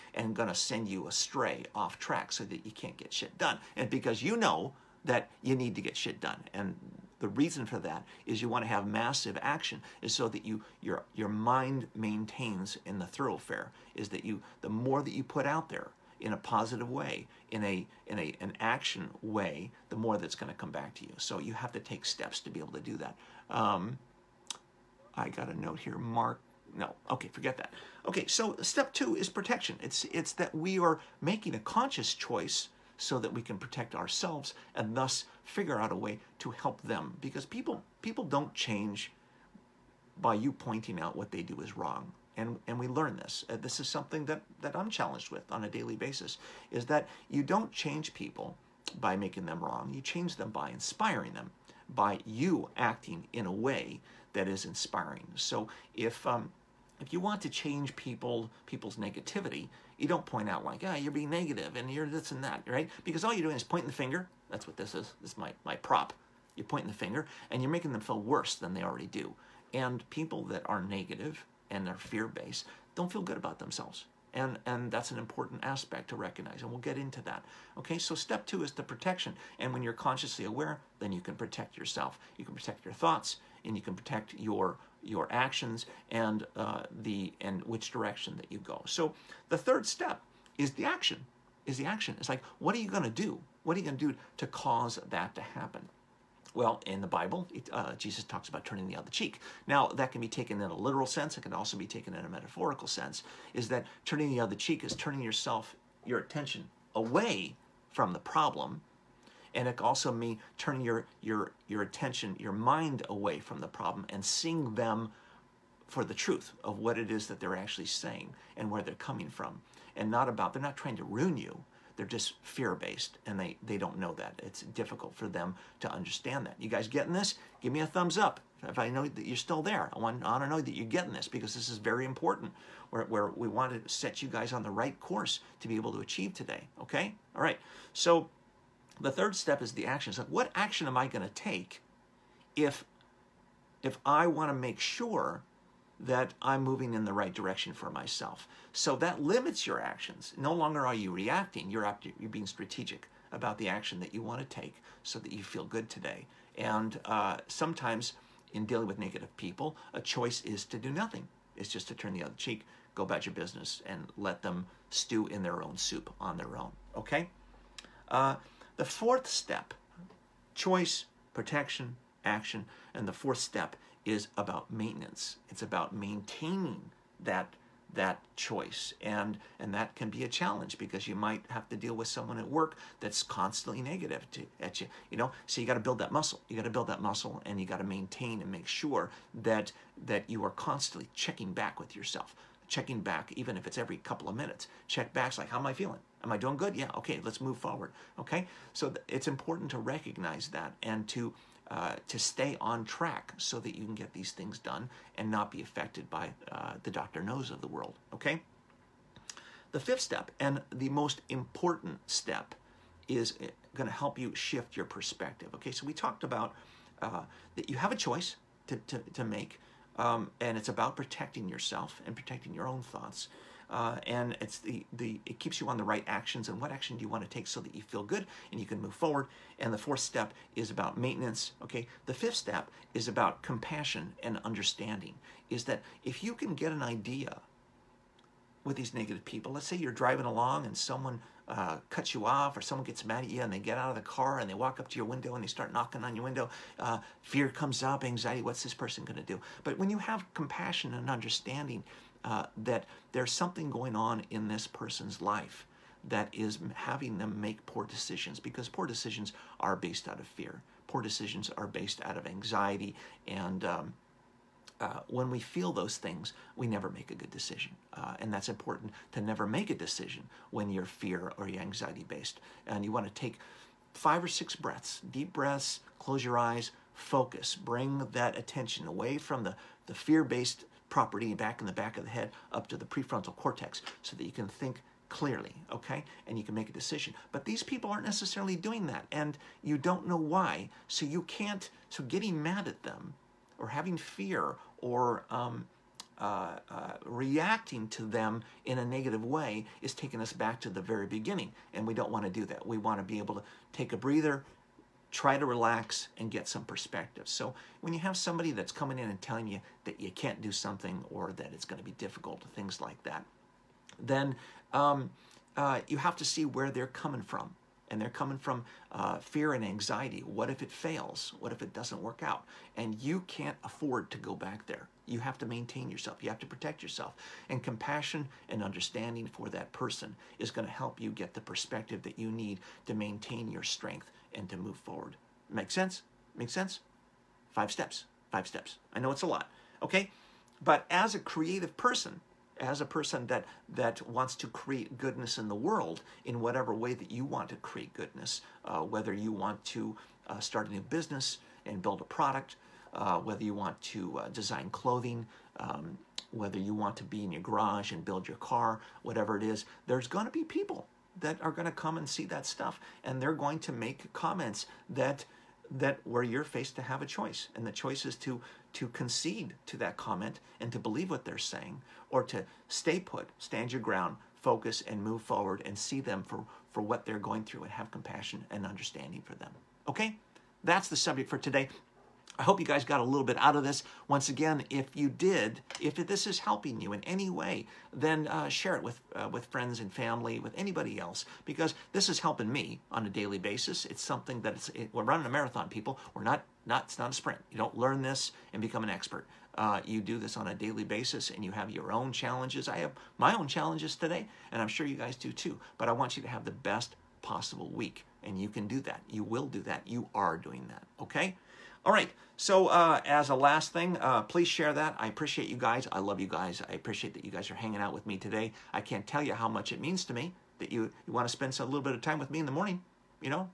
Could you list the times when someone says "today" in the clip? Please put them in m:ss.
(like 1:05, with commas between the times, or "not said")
2:16, 2:35, 6:21, 6:43, 6:58.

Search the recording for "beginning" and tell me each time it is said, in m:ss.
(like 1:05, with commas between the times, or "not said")
5:01.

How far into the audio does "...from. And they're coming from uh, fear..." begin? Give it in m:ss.
5:17.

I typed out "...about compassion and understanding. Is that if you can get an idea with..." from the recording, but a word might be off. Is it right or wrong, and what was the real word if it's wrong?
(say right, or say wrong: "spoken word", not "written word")
right.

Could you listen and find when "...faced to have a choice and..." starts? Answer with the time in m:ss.
6:06.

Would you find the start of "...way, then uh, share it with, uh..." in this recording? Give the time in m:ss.
6:27.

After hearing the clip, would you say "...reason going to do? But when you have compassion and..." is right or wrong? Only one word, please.
wrong.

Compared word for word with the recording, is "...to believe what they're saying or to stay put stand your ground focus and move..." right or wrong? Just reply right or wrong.
right.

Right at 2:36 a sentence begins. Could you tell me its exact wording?
And uh, sometimes in dealing with negative people, a choice is to do nothing.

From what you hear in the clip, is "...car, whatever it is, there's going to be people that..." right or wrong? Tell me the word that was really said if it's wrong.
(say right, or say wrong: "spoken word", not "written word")
right.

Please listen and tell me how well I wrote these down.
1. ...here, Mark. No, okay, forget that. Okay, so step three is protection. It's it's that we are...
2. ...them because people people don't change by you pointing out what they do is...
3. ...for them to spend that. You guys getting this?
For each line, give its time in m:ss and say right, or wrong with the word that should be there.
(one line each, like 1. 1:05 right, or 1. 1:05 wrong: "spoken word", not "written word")
1. 0:25 wrong: "two", not "three"
2. 0:36 right
3. 2:05 wrong: "understand", not "spend".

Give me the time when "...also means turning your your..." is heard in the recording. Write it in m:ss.
1:49.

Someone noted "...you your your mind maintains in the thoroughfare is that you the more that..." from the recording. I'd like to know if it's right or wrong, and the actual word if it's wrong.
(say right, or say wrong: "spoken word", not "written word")
right.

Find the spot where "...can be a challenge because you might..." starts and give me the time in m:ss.
2:59.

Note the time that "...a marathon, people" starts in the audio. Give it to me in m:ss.
6:35.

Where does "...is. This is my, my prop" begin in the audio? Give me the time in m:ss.
1:04.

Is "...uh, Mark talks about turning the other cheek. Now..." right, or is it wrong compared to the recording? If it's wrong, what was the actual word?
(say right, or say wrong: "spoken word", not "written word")
wrong: "Jesus", not "Mark".